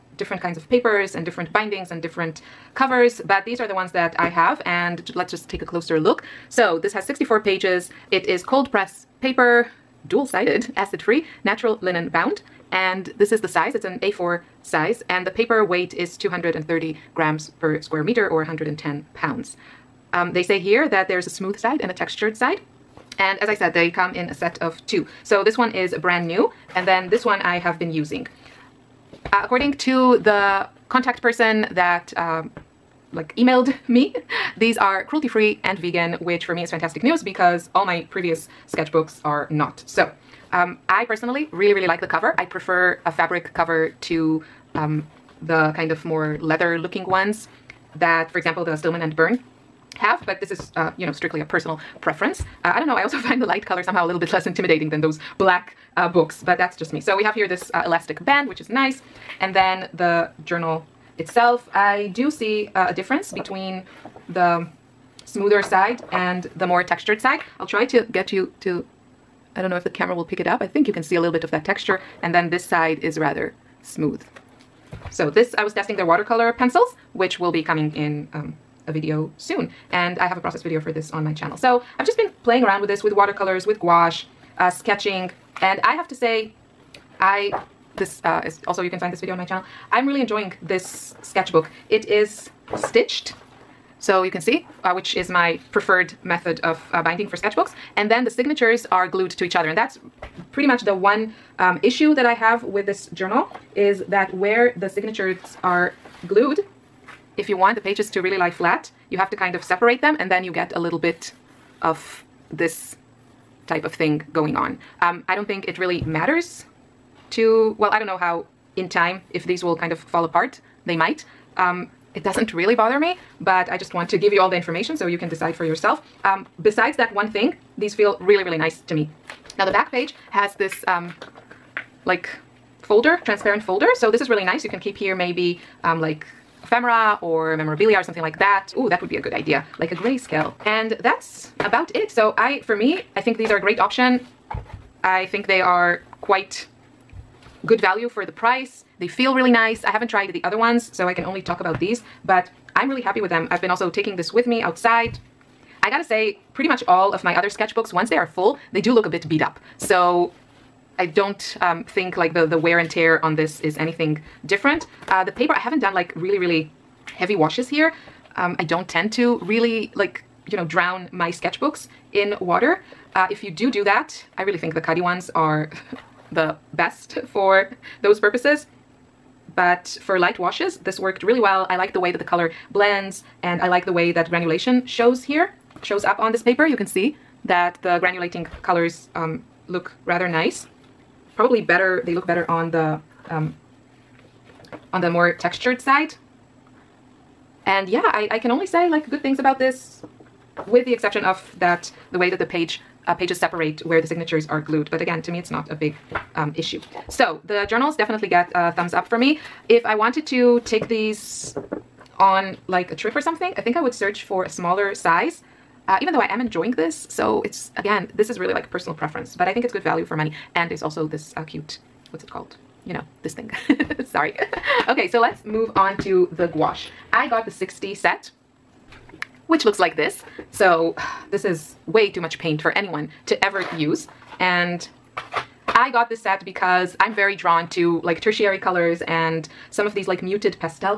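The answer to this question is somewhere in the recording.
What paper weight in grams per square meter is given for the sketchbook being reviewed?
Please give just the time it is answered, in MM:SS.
00:16.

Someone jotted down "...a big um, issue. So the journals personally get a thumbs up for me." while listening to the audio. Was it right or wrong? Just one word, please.
wrong.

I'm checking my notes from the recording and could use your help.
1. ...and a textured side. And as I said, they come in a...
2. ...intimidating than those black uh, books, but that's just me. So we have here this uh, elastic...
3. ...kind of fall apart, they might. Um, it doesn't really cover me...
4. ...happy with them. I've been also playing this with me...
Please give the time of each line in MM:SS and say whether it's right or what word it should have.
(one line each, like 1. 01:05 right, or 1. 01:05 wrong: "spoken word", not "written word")
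1. 00:21 right
2. 00:54 right
3. 01:59 wrong: "bother", not "cover"
4. 02:33 wrong: "taking", not "playing".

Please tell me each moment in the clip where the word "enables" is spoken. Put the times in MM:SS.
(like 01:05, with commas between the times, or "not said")
not said.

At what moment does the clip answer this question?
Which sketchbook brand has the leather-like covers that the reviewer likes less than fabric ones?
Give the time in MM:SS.
00:48.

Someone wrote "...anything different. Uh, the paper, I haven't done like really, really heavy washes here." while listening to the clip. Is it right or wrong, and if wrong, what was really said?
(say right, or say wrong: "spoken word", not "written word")
right.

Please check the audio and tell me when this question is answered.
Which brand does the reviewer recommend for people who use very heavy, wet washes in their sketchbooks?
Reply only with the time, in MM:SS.
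02:54.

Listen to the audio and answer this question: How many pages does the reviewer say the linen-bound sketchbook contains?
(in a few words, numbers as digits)
64.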